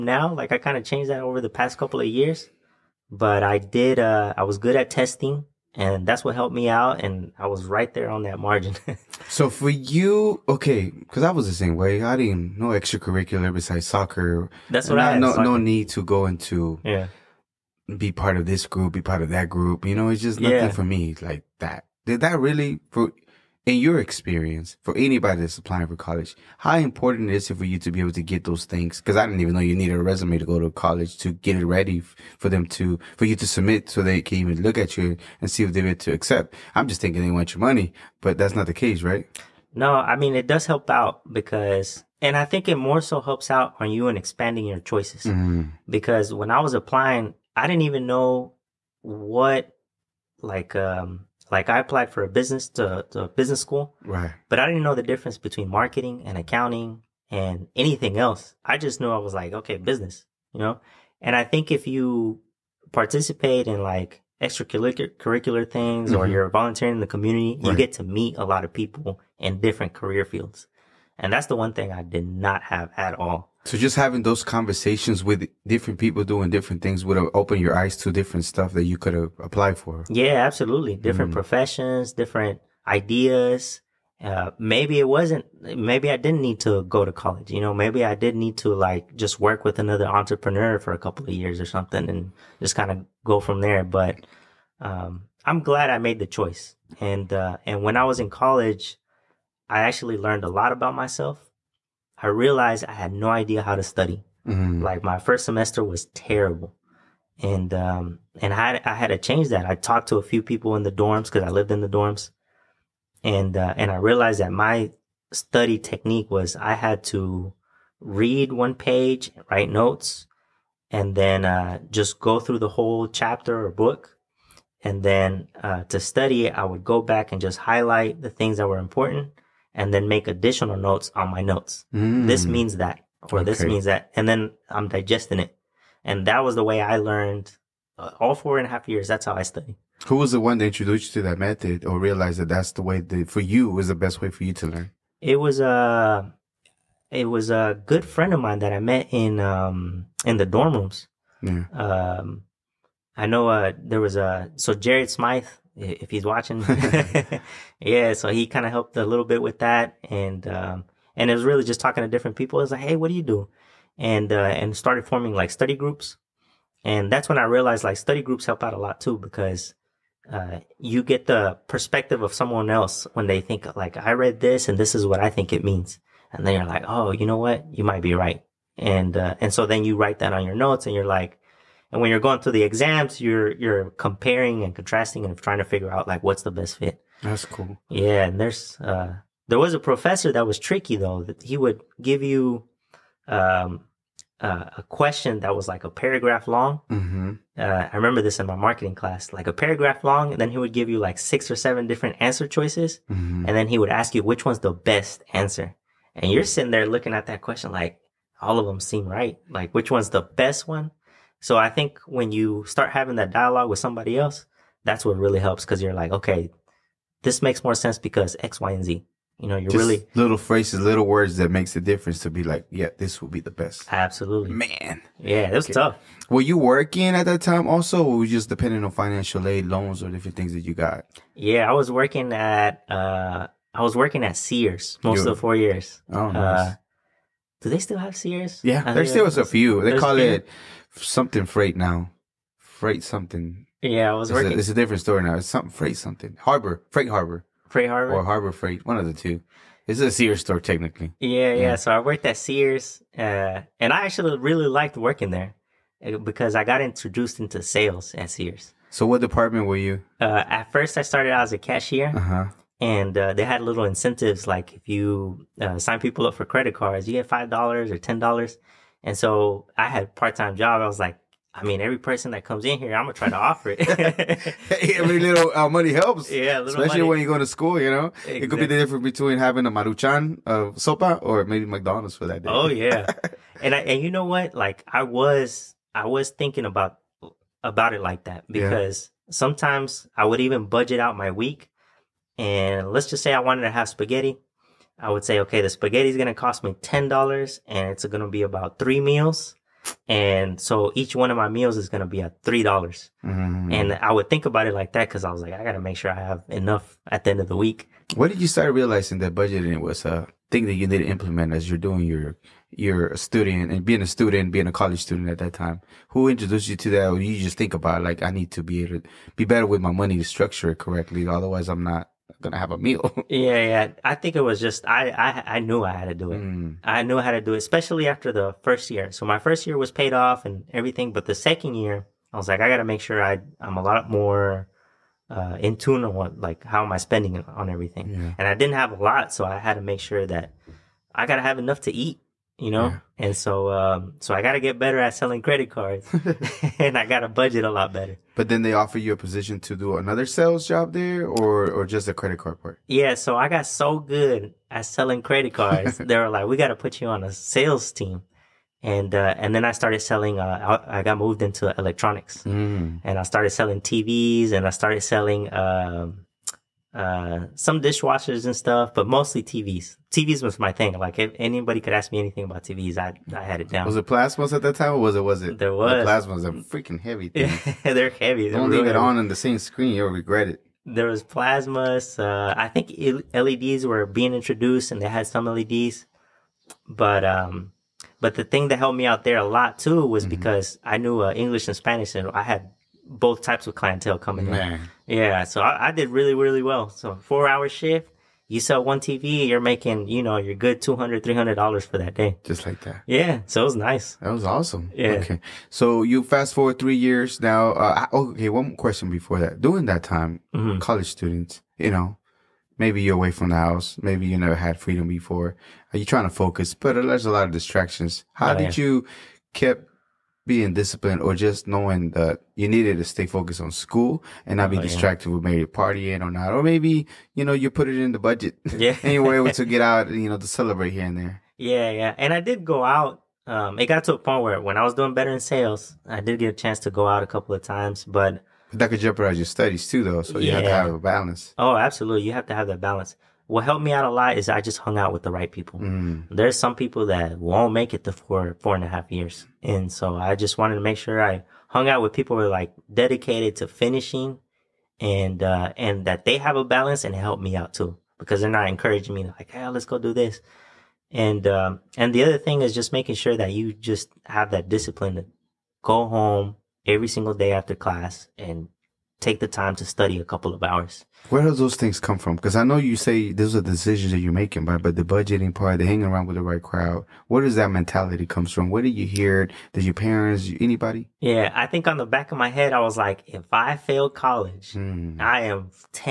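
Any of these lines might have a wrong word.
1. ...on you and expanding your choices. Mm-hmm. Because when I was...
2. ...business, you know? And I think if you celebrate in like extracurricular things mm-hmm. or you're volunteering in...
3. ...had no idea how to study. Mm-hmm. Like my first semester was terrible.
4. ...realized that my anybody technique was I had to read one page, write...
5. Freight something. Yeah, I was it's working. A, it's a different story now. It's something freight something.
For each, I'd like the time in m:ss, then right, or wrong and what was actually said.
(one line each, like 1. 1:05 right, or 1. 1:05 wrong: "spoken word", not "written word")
1. 0:43 right
2. 0:59 wrong: "participate", not "celebrate"
3. 1:42 right
4. 1:53 wrong: "study", not "anybody"
5. 4:02 right.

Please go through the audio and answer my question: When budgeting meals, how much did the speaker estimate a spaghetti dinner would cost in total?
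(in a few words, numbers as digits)
$10.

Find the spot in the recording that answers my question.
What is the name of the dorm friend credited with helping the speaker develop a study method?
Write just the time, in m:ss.
2:34.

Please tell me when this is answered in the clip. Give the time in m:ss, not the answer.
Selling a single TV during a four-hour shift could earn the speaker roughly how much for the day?
6:40.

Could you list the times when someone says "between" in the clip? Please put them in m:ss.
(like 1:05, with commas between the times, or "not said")
0:55, 4:39.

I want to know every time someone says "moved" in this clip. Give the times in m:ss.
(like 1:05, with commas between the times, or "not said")
6:01.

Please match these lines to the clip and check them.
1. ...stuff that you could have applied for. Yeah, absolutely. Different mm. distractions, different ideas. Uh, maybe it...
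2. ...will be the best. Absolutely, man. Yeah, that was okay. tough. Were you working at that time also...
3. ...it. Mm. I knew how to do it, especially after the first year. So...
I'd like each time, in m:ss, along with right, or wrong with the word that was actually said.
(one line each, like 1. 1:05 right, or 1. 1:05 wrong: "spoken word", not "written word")
1. 1:18 wrong: "professions", not "distractions"
2. 3:43 right
3. 5:26 right.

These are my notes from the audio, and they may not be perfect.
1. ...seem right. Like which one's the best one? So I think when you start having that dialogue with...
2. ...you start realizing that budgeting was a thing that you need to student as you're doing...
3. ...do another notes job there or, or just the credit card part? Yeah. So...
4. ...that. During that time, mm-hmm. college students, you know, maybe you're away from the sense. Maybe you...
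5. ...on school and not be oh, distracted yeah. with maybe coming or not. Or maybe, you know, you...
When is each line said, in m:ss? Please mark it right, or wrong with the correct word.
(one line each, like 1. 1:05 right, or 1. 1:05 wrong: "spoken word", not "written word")
1. 3:28 right
2. 5:08 wrong: "implement", not "student"
3. 5:49 wrong: "sales", not "notes"
4. 6:49 wrong: "house", not "sense"
5. 7:03 wrong: "partying", not "coming".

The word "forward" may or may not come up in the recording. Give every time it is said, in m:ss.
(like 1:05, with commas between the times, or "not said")
6:46.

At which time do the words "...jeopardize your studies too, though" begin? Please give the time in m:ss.
7:19.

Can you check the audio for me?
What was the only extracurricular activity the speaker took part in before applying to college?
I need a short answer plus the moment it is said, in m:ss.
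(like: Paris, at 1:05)
Soccer, at 0:13.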